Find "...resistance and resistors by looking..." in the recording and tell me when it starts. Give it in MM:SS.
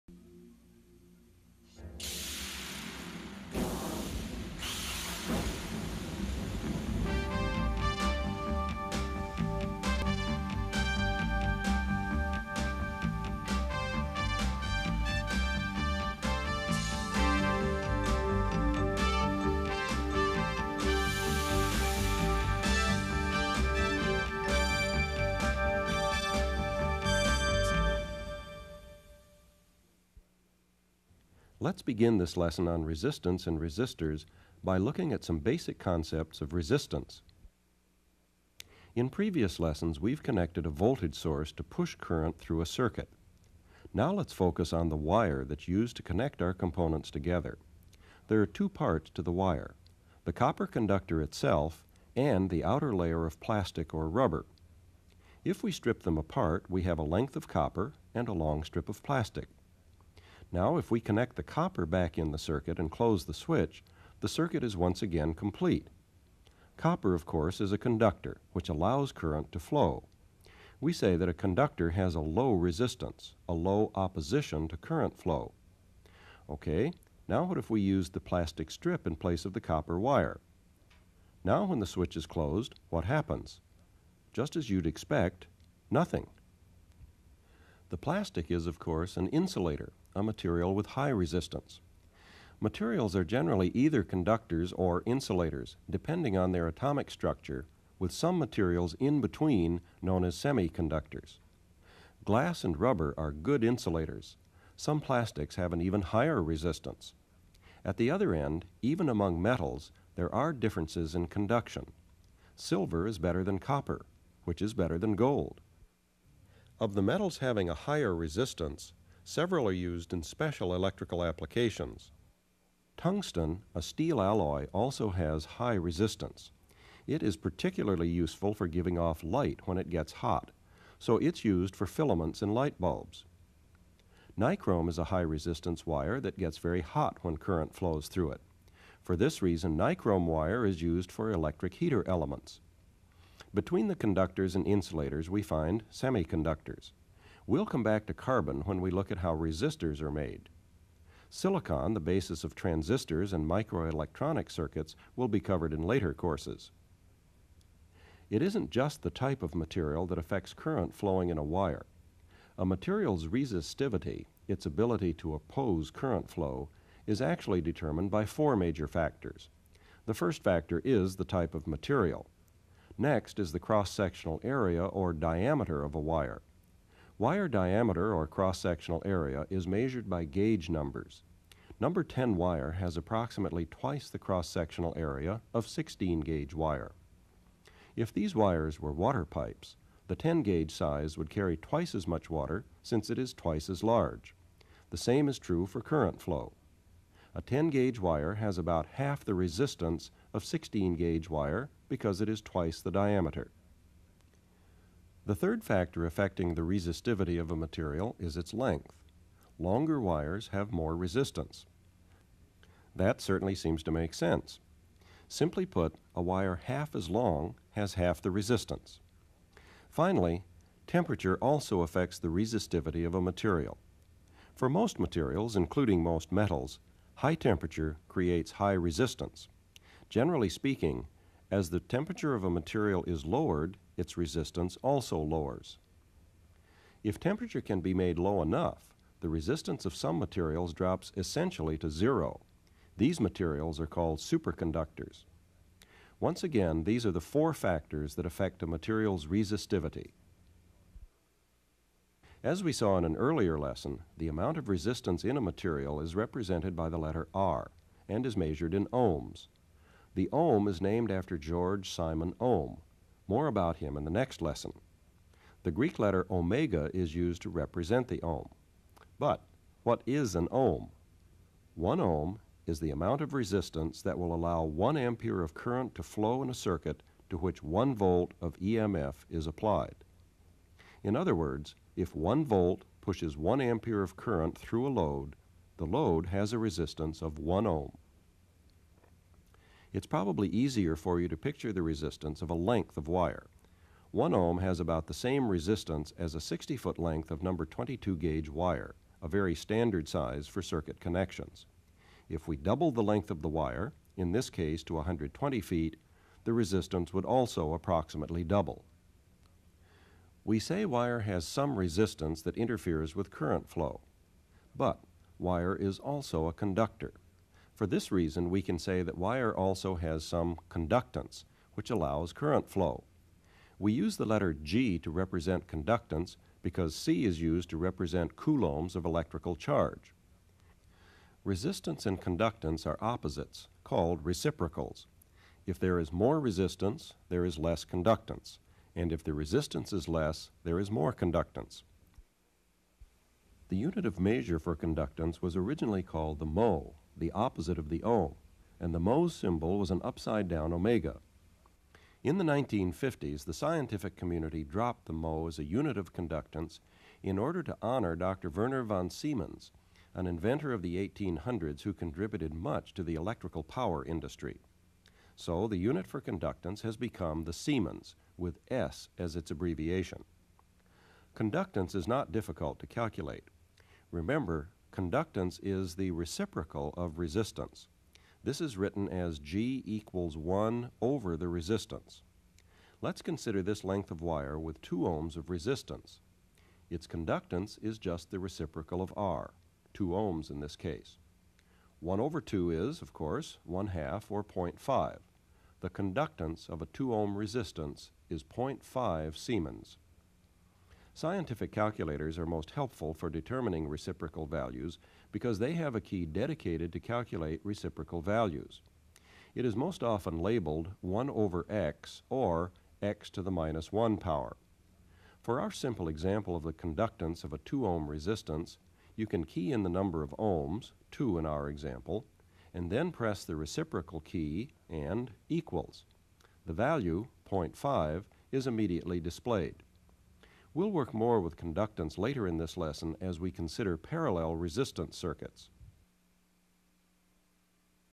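00:32.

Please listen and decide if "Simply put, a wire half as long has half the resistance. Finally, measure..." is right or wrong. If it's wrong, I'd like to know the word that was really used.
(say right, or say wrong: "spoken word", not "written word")
wrong: "temperature", not "measure".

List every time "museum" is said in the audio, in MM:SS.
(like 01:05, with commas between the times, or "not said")
not said.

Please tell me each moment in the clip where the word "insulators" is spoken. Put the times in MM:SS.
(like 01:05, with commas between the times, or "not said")
01:29, 01:35, 01:43, 02:24.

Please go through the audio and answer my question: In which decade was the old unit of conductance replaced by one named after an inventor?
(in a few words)
1950s.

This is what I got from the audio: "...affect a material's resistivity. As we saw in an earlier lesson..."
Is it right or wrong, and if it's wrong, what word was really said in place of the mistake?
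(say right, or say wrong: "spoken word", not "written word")
right.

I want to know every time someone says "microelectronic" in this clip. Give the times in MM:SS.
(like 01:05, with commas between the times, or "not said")
02:33.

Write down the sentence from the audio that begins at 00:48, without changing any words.
There are two parts to the wire, the copper conductor itself and the outer layer of plastic or rubber.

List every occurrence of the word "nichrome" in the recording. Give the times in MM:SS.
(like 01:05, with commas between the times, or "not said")
02:14, 02:19.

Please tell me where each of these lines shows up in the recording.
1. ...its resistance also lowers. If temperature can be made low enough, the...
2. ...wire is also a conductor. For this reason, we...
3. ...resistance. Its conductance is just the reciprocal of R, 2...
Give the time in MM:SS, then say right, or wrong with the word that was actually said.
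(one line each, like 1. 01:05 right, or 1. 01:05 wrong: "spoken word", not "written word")
1. 03:53 right
2. 05:15 right
3. 06:25 right.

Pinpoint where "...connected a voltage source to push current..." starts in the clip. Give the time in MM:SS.
00:40.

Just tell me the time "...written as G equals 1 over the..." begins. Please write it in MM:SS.
06:18.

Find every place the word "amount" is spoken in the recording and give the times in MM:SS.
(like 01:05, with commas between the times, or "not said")
04:14, 04:32.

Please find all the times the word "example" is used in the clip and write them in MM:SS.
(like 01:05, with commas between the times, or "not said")
06:56, 07:01.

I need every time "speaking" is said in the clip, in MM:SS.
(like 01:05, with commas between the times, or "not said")
03:50.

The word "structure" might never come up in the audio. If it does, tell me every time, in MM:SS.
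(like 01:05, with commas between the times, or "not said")
01:37.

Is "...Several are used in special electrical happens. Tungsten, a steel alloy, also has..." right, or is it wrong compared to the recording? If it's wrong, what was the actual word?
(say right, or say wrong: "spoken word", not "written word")
wrong: "applications", not "happens".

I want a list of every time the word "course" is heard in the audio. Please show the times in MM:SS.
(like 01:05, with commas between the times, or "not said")
01:07, 01:28, 02:36, 06:33.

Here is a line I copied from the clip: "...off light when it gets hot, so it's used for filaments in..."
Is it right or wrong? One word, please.
right.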